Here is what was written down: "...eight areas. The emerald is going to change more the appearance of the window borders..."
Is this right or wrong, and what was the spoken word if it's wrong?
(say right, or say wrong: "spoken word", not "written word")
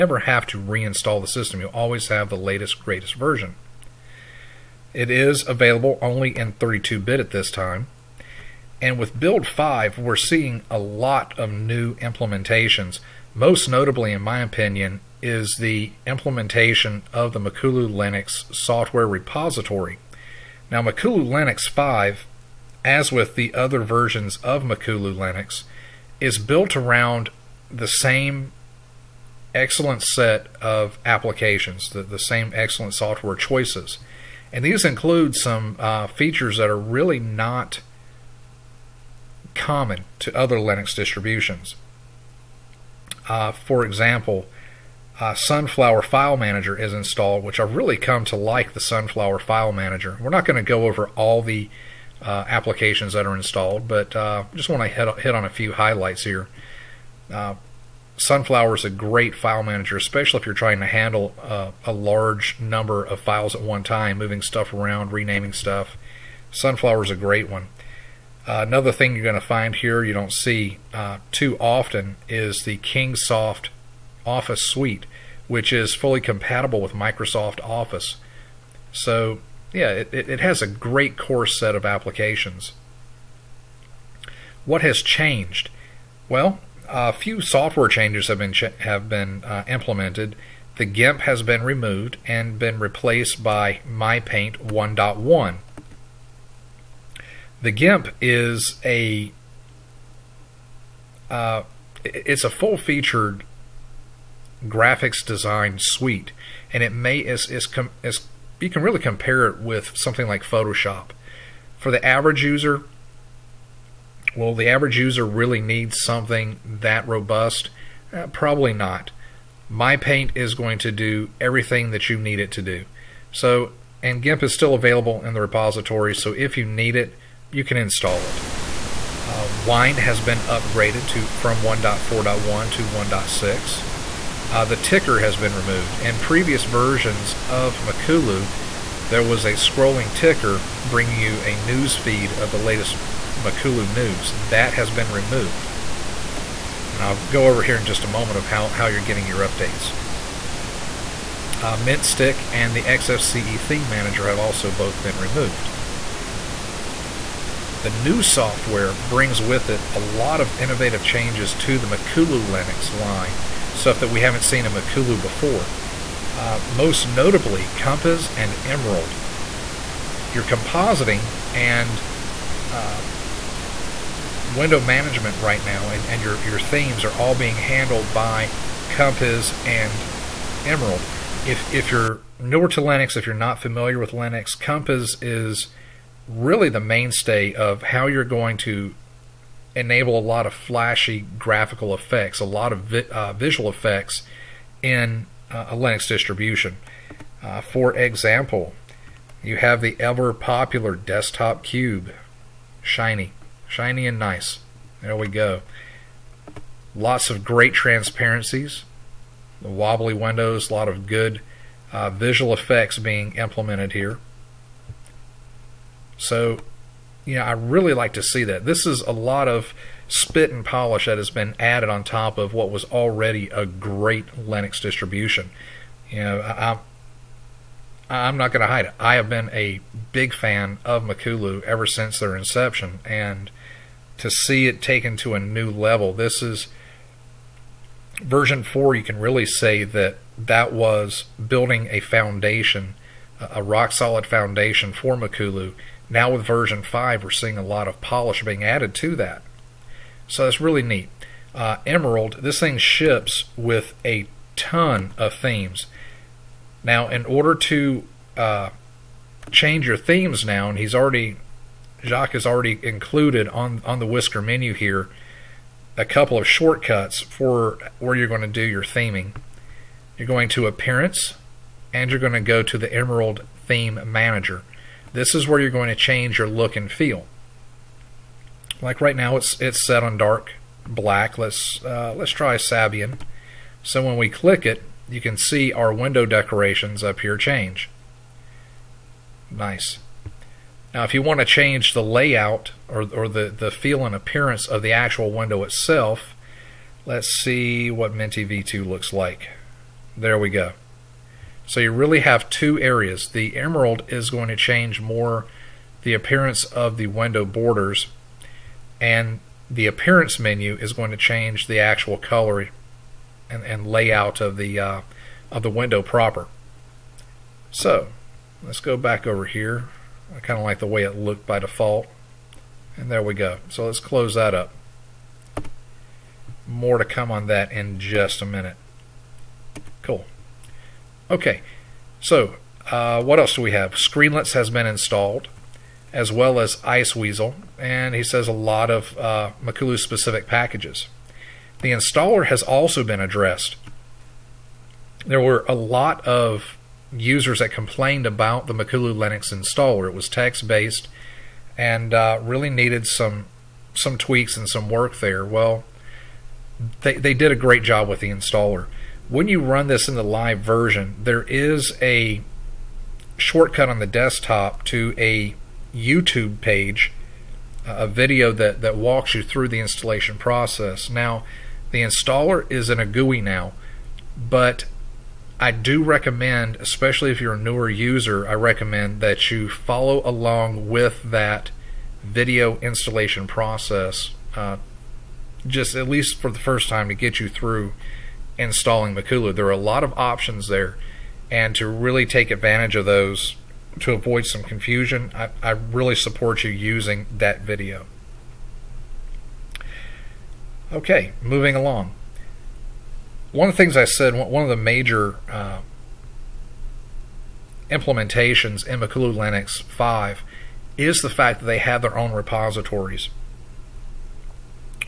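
wrong: "two", not "eight".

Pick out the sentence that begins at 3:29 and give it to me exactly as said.
The wobbly windows, a lot of good uh, visual effects being implemented here.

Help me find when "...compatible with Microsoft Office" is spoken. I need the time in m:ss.
1:16.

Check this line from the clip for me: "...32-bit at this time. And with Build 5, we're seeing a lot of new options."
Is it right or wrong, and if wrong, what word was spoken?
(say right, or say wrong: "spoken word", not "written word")
wrong: "implementations", not "options".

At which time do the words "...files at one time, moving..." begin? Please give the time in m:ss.
1:03.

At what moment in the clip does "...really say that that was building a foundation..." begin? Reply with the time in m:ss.
3:59.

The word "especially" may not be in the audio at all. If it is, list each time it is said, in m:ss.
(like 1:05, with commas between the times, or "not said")
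0:59, 6:16.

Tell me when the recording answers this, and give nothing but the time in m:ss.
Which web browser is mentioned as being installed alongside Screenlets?
5:36.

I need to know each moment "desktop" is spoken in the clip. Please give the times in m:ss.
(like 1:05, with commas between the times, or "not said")
3:20, 6:04.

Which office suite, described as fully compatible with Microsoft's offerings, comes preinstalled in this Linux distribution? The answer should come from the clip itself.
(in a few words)
Kingsoft Office Suite.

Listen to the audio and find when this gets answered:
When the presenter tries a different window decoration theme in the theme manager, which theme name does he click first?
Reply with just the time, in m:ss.
4:42.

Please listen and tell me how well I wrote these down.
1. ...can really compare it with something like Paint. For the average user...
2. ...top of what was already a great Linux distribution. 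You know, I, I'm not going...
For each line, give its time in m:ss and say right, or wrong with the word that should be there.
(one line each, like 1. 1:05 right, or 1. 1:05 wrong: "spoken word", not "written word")
1. 1:48 wrong: "Photoshop", not "Paint"
2. 3:42 right.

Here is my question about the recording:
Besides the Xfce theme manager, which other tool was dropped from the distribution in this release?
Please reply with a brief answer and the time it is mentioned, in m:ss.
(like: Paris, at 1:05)
mintStick, at 2:31.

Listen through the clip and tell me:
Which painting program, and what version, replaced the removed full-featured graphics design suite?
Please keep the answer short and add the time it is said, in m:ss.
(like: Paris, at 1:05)
MyPaint 1.1, at 1:33.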